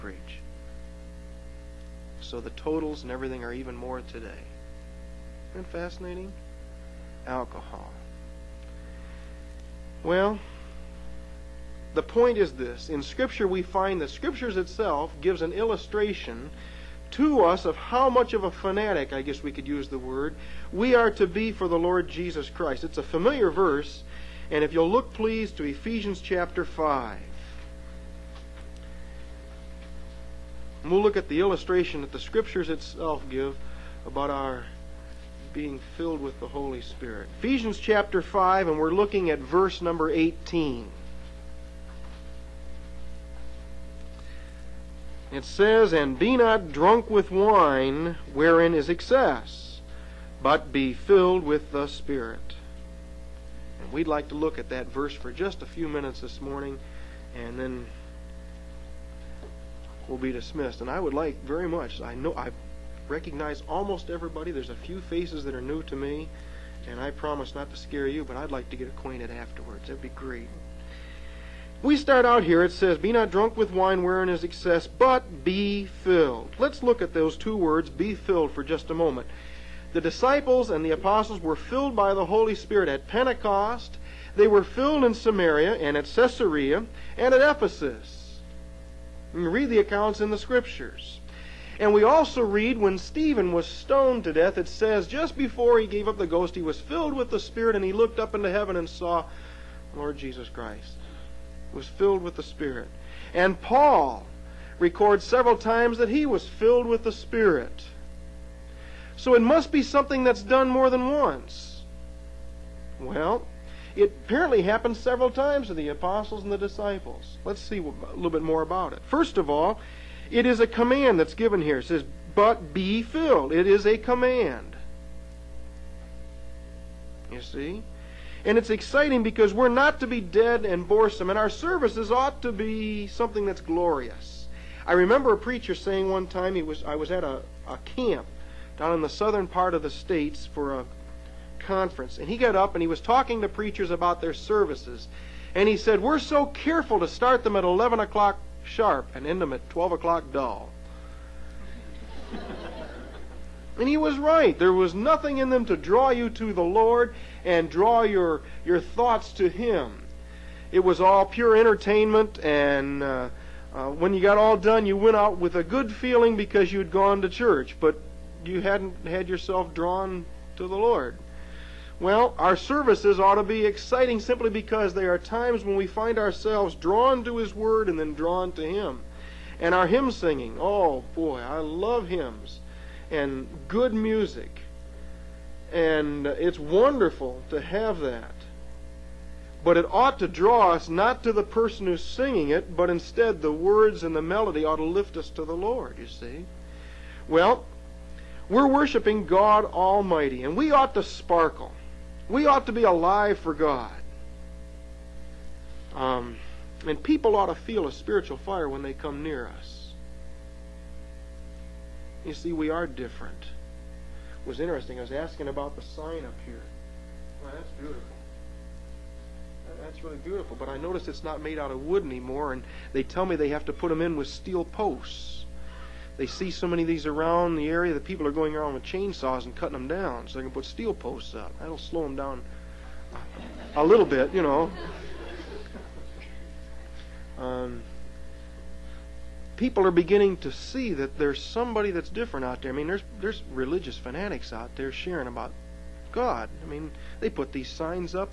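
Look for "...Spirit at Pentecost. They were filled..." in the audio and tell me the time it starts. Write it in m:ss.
1:22.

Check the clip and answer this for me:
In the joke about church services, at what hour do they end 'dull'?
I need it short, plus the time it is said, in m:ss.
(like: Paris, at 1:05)
12 o'clock, at 2:29.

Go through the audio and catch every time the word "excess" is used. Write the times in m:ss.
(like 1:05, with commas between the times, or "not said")
0:48, 1:14.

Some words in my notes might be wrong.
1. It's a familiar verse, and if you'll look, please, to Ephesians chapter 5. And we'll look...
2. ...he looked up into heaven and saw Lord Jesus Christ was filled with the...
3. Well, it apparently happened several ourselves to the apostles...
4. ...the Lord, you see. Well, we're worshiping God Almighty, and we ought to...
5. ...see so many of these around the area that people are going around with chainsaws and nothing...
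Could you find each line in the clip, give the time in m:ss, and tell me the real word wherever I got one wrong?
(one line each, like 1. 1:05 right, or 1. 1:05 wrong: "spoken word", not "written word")
1. 0:22 right
2. 1:37 right
3. 1:52 wrong: "times", not "ourselves"
4. 3:15 right
5. 3:46 wrong: "cutting", not "nothing".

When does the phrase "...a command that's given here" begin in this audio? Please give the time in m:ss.
2:00.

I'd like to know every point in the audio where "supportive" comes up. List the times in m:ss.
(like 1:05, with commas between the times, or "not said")
not said.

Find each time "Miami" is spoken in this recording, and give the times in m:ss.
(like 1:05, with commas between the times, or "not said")
not said.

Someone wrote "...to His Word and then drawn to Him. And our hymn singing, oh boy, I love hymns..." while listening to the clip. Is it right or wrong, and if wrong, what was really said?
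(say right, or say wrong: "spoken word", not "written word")
right.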